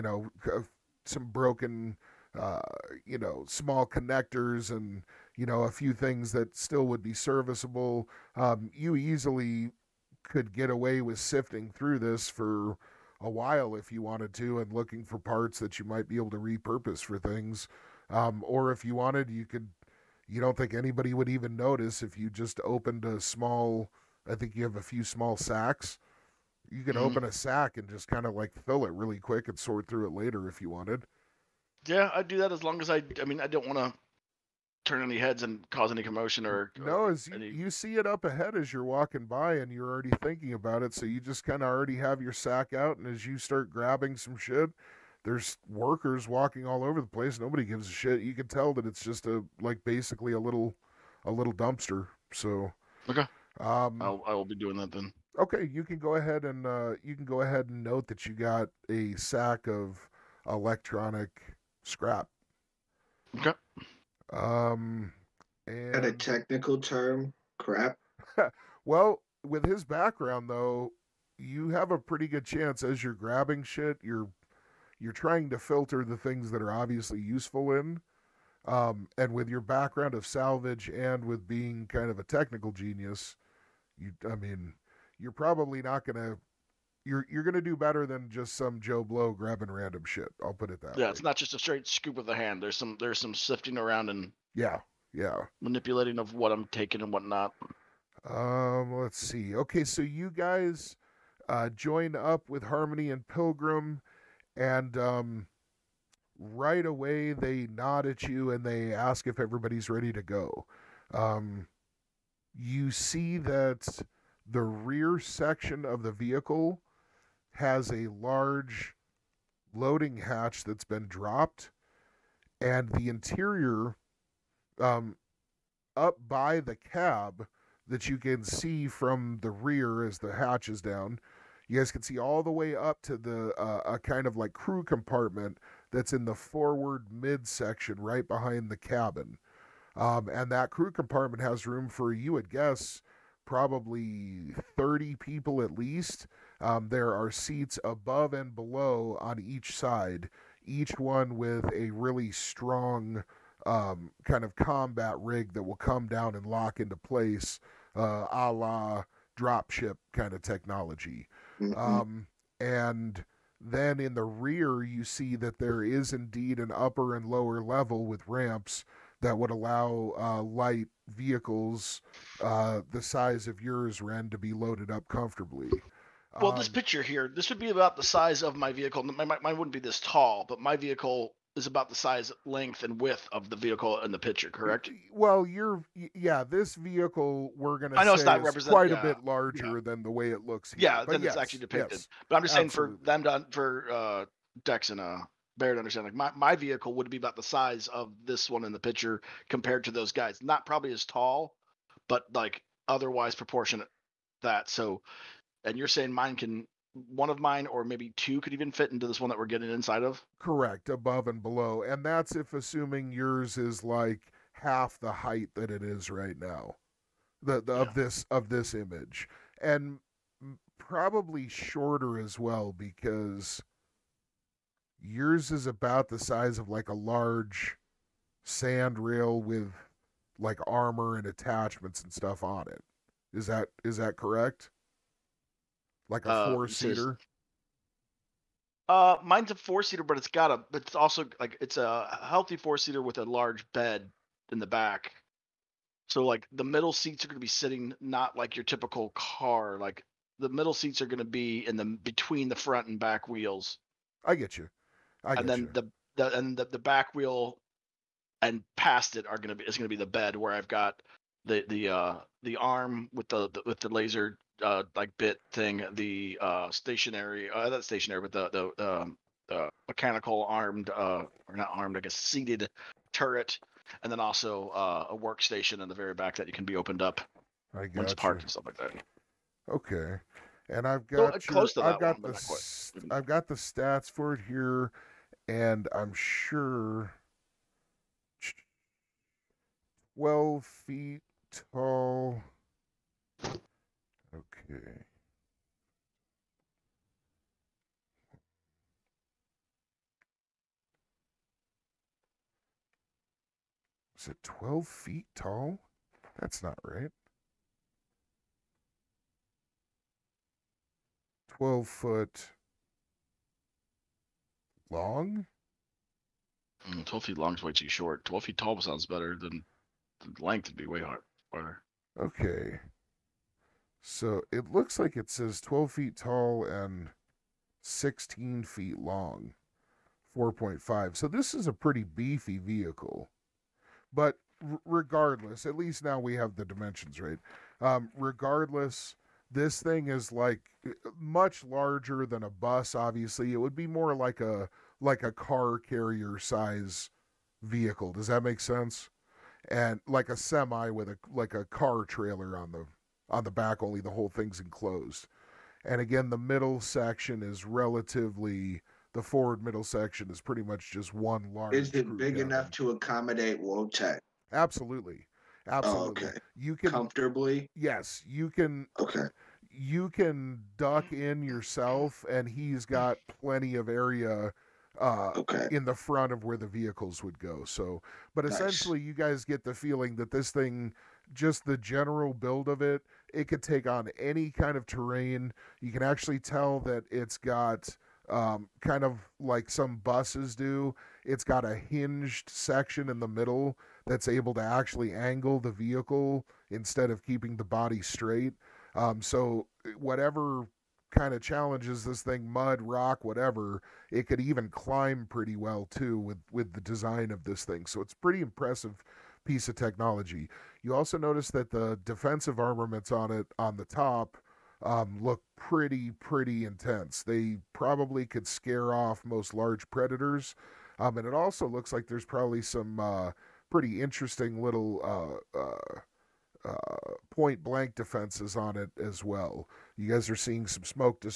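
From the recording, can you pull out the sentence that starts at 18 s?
Um, or if you wanted, you could.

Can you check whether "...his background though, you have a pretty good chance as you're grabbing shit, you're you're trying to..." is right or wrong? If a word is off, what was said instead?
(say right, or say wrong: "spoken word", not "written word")
right.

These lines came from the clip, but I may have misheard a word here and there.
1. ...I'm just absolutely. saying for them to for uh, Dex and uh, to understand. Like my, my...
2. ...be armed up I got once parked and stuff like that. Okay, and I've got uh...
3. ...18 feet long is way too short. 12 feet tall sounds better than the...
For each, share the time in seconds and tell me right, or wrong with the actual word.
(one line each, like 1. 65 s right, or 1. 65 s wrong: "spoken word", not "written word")
1. 192 s right
2. 276 s wrong: "opened", not "armed"
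3. 317 s wrong: "12", not "18".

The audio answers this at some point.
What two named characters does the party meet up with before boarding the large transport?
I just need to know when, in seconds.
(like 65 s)
102 s.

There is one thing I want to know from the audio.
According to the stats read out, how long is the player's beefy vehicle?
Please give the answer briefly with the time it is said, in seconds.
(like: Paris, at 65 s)
16 feet, at 327 s.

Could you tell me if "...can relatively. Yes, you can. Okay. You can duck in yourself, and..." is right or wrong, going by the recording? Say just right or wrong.
wrong.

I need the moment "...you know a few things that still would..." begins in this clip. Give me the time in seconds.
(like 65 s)
5 s.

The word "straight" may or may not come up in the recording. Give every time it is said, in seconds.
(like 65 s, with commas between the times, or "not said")
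91 s, 398 s.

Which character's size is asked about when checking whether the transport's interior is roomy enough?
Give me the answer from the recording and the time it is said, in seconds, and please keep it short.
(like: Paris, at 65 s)
Wotek, at 363 s.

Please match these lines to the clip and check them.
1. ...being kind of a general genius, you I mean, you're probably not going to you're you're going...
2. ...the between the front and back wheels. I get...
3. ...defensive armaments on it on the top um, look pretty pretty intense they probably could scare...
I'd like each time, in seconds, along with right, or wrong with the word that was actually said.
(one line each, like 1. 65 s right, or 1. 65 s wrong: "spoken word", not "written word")
1. 81 s wrong: "technical", not "general"
2. 251 s right
3. 412 s right.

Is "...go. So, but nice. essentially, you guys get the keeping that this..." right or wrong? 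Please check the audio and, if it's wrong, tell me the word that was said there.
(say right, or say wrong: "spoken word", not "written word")
wrong: "feeling", not "keeping".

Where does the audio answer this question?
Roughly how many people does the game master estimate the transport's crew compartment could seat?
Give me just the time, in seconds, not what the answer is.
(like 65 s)
144 s.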